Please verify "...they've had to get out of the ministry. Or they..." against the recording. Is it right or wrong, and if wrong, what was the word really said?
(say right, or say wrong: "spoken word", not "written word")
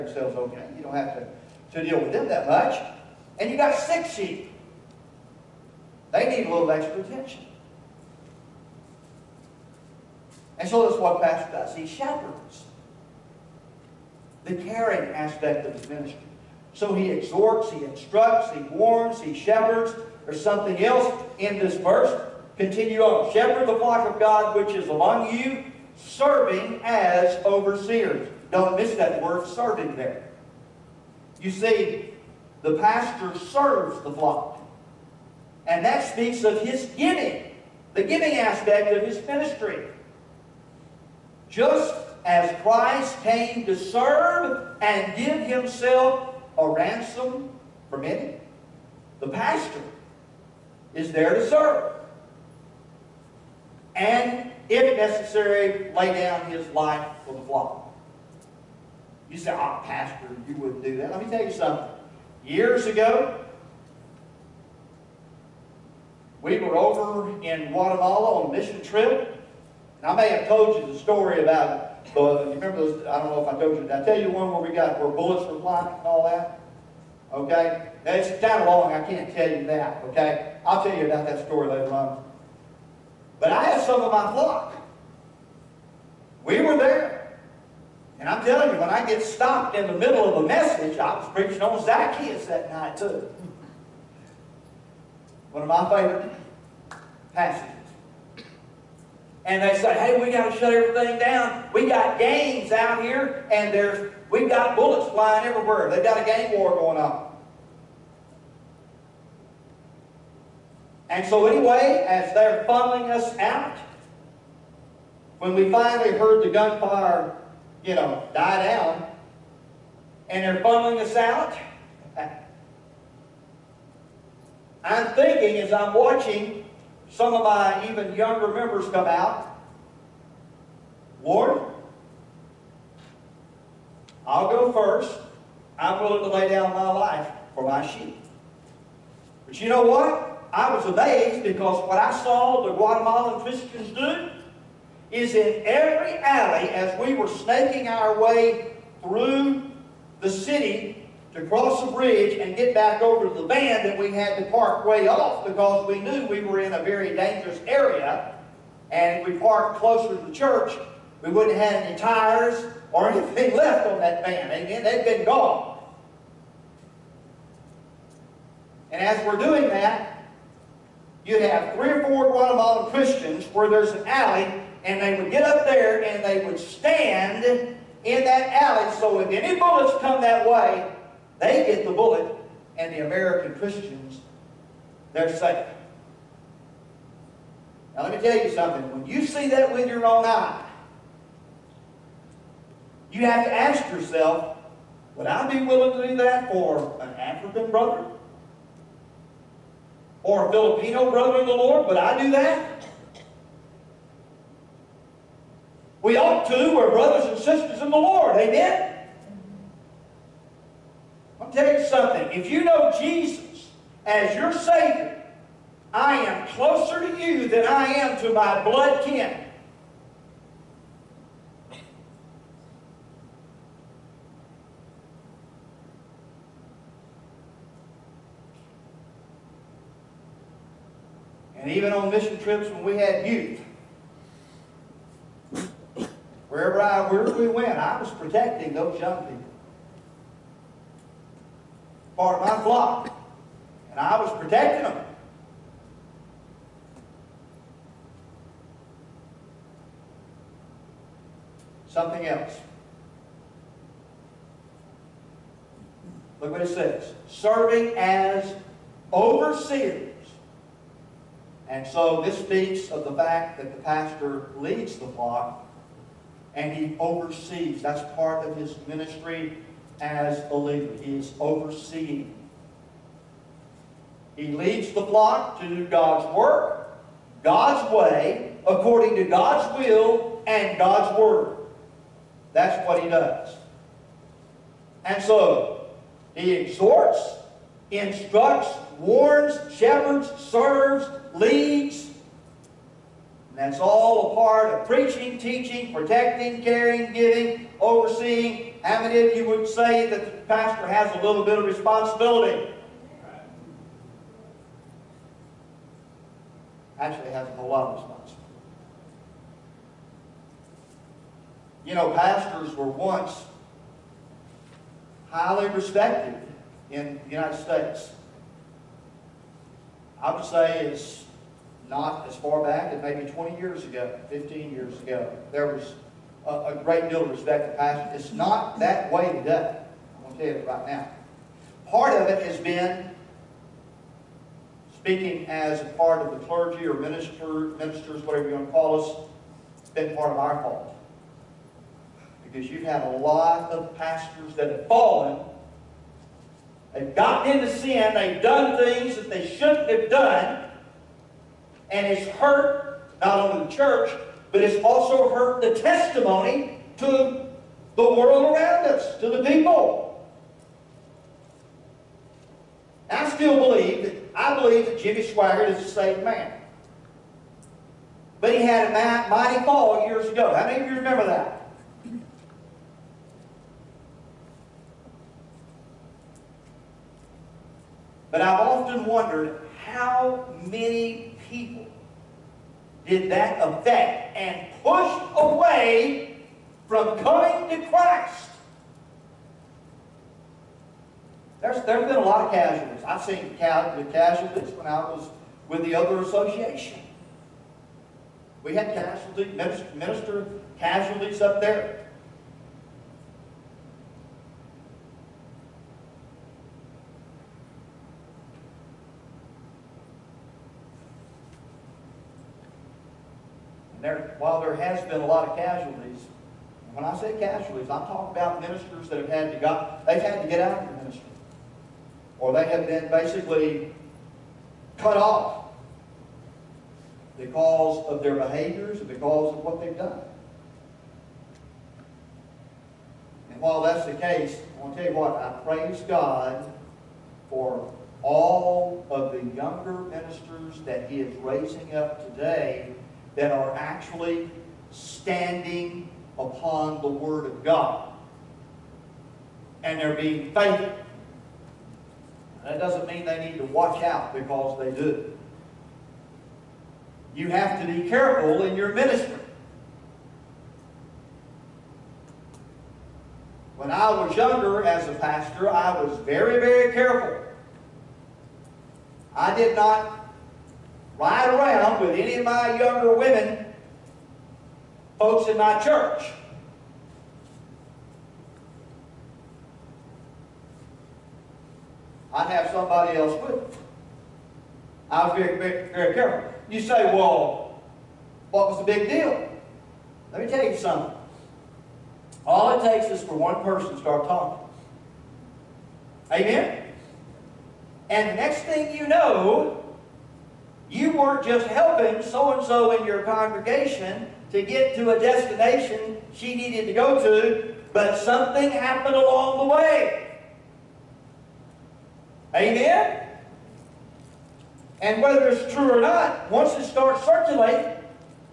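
right.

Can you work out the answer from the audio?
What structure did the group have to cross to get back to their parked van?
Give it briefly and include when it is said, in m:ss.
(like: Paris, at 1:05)
the bridge, at 2:31.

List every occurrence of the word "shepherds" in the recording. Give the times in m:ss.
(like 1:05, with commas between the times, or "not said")
0:11, 0:19, 0:23, 4:49.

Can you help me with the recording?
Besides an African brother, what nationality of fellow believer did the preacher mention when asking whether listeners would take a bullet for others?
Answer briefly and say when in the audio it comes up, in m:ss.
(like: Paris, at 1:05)
Filipino, at 3:20.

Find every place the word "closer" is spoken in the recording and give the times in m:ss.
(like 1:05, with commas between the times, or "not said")
2:39, 3:36.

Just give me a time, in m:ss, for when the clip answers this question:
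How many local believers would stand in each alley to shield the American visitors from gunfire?
2:51.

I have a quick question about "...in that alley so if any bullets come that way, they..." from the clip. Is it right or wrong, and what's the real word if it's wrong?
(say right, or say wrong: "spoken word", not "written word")
right.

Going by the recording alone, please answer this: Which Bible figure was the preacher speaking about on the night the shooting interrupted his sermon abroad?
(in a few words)
Zacchaeus.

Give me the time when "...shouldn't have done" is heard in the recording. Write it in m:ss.
5:49.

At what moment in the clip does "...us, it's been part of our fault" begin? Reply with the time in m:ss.
5:39.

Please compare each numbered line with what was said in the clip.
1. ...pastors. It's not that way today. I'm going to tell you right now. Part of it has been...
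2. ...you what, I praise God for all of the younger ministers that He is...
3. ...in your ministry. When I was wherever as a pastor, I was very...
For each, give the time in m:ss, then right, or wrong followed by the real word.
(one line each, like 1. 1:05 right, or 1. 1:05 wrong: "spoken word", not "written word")
1. 5:27 right
2. 7:15 right
3. 7:38 wrong: "younger", not "wherever".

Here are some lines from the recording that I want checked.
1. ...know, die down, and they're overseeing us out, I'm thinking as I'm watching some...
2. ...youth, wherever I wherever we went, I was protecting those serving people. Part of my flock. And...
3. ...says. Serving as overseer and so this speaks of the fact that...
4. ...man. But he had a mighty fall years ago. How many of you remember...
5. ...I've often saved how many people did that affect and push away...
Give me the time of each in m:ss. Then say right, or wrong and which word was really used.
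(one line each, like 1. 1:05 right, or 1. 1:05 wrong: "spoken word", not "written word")
1. 1:57 wrong: "funneling", not "overseeing"
2. 3:53 wrong: "young", not "serving"
3. 4:16 right
4. 6:06 right
5. 6:18 wrong: "wondered", not "saved".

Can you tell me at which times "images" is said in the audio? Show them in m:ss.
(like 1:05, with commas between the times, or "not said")
not said.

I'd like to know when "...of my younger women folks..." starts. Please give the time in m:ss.
7:52.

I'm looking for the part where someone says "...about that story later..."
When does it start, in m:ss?
1:21.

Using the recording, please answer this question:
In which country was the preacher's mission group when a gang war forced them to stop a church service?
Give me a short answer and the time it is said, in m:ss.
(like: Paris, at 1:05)
Guatemala, at 1:07.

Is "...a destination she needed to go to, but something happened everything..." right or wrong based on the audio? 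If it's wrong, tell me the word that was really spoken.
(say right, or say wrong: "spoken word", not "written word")
wrong: "along", not "everything".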